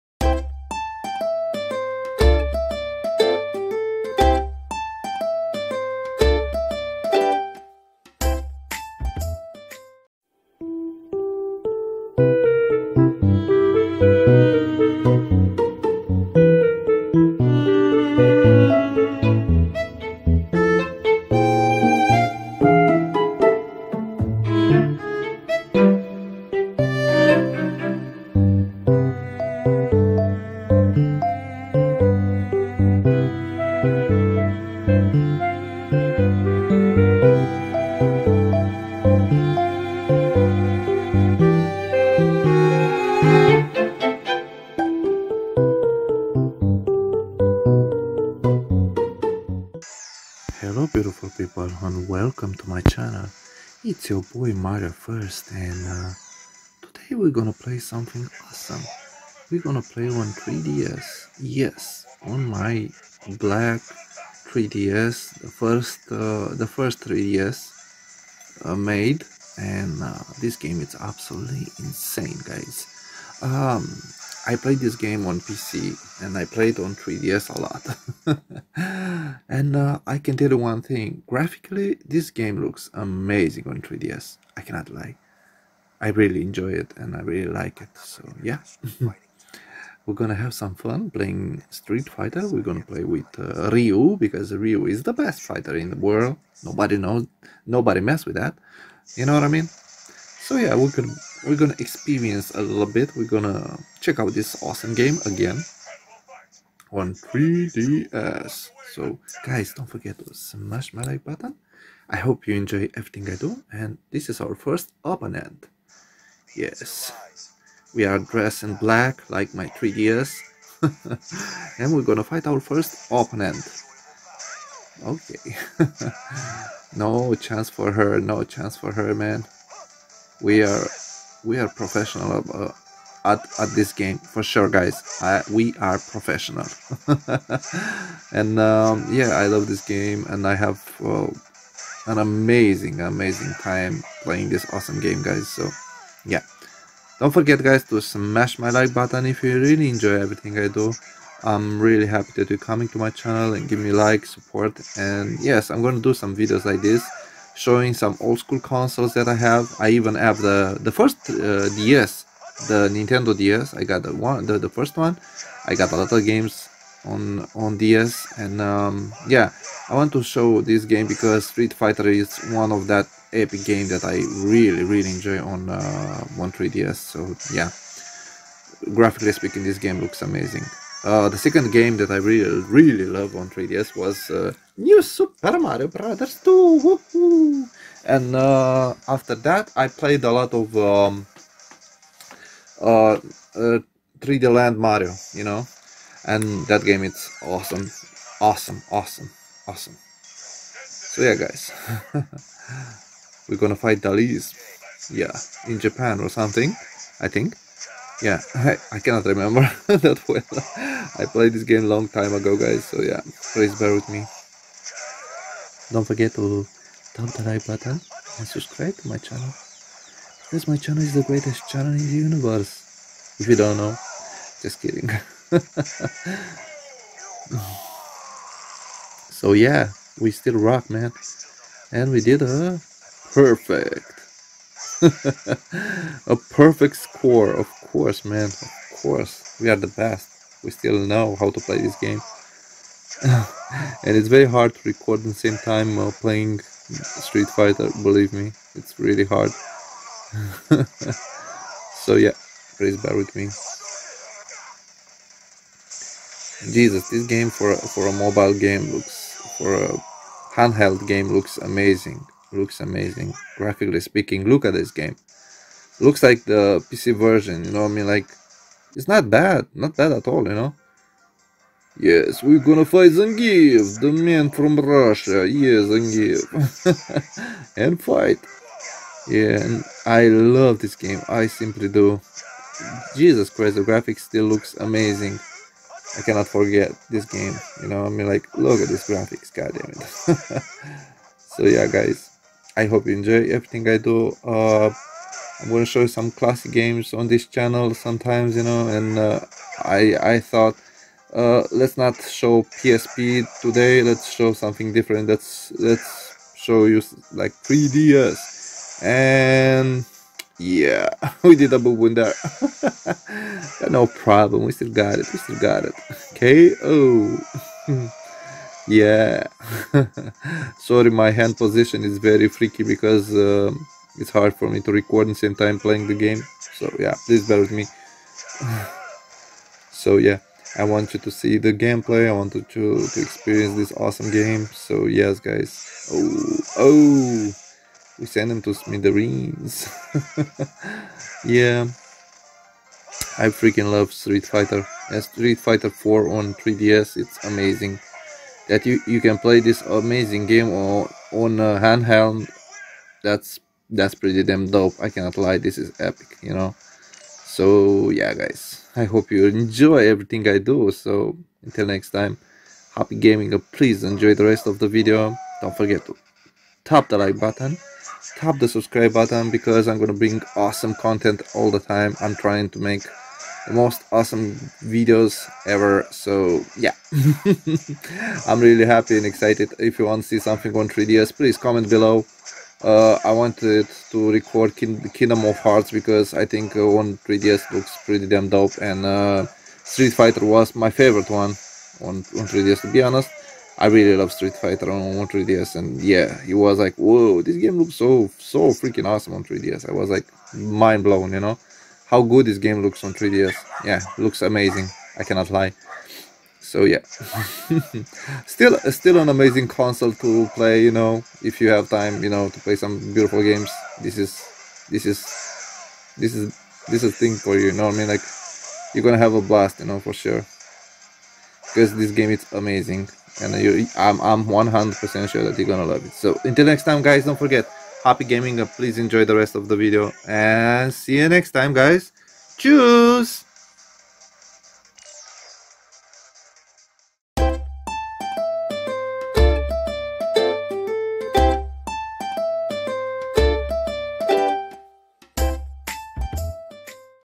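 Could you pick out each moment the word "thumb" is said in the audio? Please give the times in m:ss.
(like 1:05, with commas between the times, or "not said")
3:37.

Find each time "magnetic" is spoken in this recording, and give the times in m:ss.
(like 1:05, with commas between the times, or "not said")
not said.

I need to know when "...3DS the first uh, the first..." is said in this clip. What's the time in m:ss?
1:04.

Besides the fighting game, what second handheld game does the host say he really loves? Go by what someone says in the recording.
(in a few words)
New Super Mario Brothers 2.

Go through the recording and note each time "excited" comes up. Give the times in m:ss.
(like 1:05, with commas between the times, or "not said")
6:19.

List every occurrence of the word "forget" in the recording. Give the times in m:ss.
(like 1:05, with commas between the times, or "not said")
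1:49, 2:27, 3:36, 4:46, 6:05, 7:07.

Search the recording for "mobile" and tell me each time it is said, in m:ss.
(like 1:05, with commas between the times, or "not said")
4:18.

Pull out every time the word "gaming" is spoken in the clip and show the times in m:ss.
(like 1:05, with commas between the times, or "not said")
6:03, 7:08.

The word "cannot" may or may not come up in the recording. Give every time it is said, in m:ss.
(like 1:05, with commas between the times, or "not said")
1:24, 3:28, 4:46, 5:55, 6:45.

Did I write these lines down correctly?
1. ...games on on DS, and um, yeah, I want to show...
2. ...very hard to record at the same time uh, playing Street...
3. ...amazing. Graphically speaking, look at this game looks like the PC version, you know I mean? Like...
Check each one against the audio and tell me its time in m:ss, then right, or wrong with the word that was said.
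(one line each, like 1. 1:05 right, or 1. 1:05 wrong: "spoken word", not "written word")
1. 2:46 right
2. 4:04 right
3. 4:22 right.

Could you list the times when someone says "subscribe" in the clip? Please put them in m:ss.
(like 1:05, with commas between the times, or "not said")
3:38, 6:08.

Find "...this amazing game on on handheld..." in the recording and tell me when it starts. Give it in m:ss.
5:49.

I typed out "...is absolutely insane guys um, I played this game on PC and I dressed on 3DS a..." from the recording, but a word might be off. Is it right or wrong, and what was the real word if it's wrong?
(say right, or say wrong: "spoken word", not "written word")
wrong: "played", not "dressed".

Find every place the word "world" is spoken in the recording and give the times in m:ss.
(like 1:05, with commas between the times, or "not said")
1:35.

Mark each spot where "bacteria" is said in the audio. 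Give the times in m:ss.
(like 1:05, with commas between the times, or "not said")
not said.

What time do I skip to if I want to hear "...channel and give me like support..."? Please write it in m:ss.
2:33.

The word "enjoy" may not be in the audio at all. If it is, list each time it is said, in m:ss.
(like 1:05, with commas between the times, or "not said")
1:26, 1:52, 2:29, 2:55, 4:53, 5:59, 6:04, 7:08.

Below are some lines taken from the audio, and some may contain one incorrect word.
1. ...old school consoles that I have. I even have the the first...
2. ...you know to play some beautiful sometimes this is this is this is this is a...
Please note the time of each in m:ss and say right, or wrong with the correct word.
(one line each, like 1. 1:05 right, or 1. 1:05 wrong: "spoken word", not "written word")
1. 2:38 right
2. 6:52 wrong: "games", not "sometimes".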